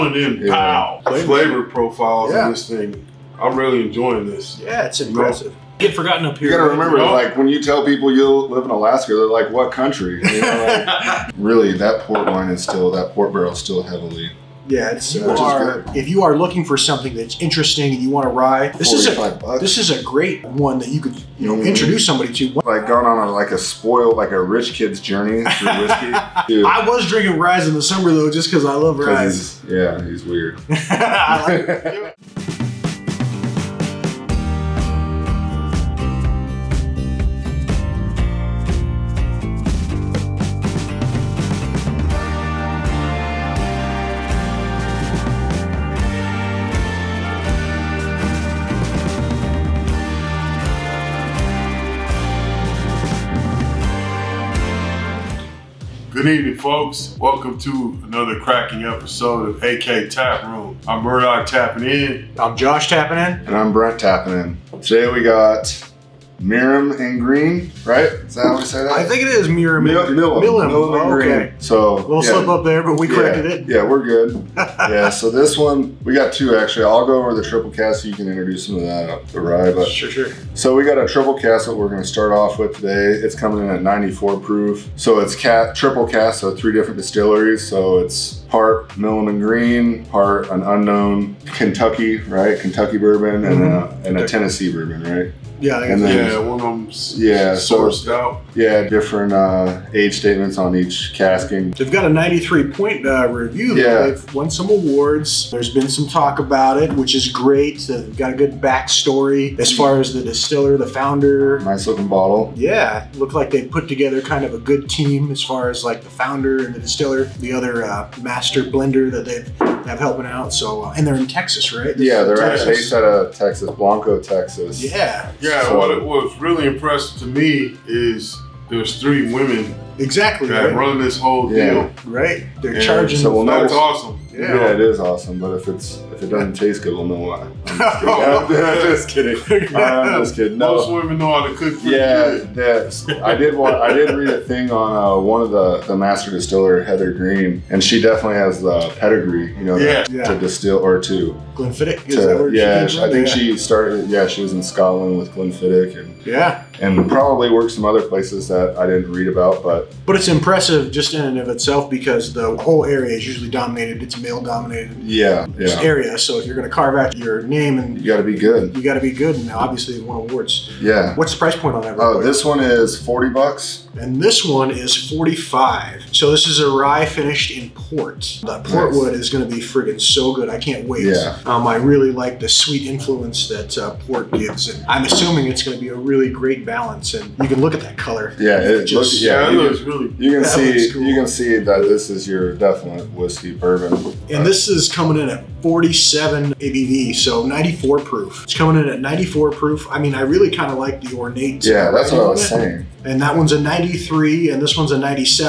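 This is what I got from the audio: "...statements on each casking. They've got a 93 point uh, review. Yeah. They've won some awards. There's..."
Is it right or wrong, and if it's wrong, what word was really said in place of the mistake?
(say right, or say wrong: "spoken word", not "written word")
right.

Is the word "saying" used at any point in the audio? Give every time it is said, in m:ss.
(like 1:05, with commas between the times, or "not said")
3:22.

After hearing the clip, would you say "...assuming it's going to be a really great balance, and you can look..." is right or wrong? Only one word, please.
right.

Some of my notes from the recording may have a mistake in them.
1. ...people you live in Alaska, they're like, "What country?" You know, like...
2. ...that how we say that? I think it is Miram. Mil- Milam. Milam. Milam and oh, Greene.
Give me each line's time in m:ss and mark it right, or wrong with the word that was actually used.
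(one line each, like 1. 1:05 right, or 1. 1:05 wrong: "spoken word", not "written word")
1. 0:07 right
2. 1:08 right.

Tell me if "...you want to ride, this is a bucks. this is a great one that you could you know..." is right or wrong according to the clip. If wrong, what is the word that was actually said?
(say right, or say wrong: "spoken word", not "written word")
right.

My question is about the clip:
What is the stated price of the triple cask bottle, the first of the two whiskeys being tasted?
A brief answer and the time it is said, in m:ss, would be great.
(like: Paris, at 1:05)
40 bucks, at 2:53.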